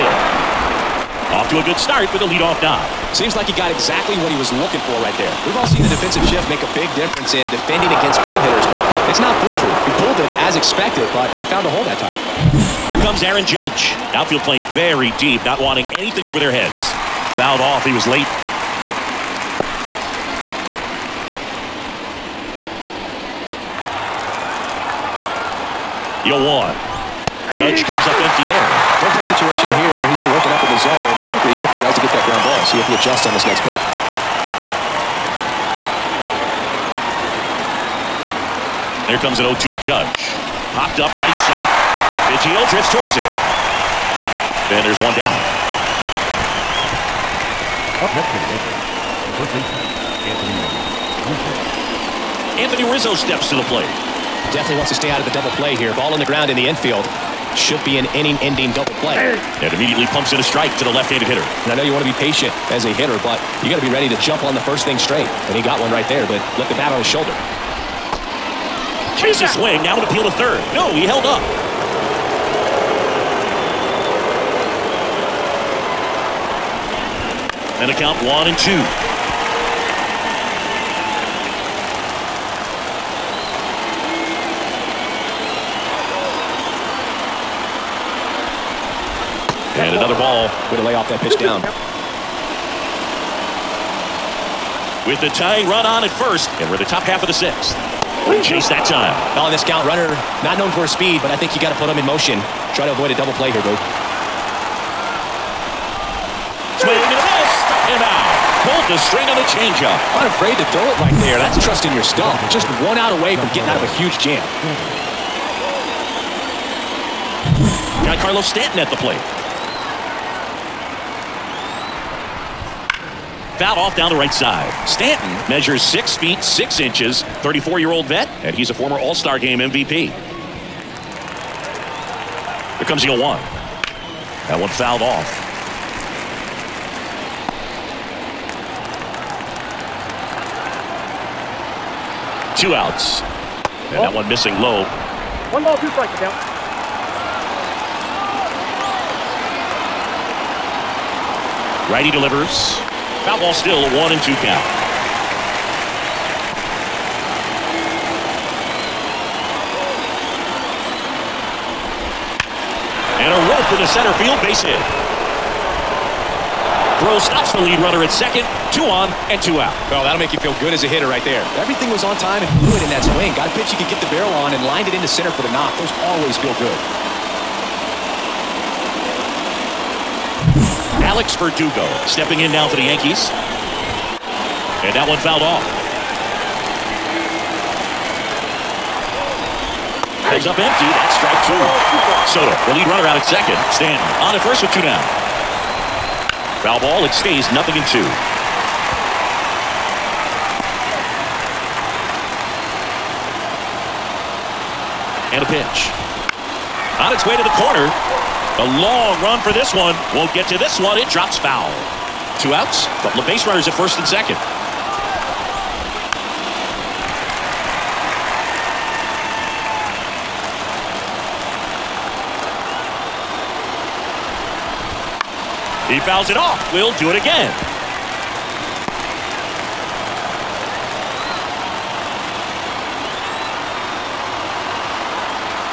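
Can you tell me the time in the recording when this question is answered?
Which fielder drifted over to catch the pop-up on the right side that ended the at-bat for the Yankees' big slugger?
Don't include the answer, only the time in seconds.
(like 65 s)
42 s.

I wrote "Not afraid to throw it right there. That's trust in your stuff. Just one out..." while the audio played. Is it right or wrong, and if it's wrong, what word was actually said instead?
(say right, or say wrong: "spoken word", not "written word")
right.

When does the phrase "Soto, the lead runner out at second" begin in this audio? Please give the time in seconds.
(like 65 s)
192 s.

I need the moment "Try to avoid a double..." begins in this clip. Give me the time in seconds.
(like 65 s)
102 s.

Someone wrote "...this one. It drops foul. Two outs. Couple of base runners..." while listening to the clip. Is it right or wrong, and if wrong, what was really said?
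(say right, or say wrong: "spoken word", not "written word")
right.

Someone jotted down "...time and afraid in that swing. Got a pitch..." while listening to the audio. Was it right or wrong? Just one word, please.
wrong.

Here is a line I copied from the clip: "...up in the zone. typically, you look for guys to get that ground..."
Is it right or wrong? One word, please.
right.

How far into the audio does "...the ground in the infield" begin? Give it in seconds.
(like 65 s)
56 s.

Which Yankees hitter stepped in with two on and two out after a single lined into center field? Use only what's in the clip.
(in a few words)
Alex Verdugo.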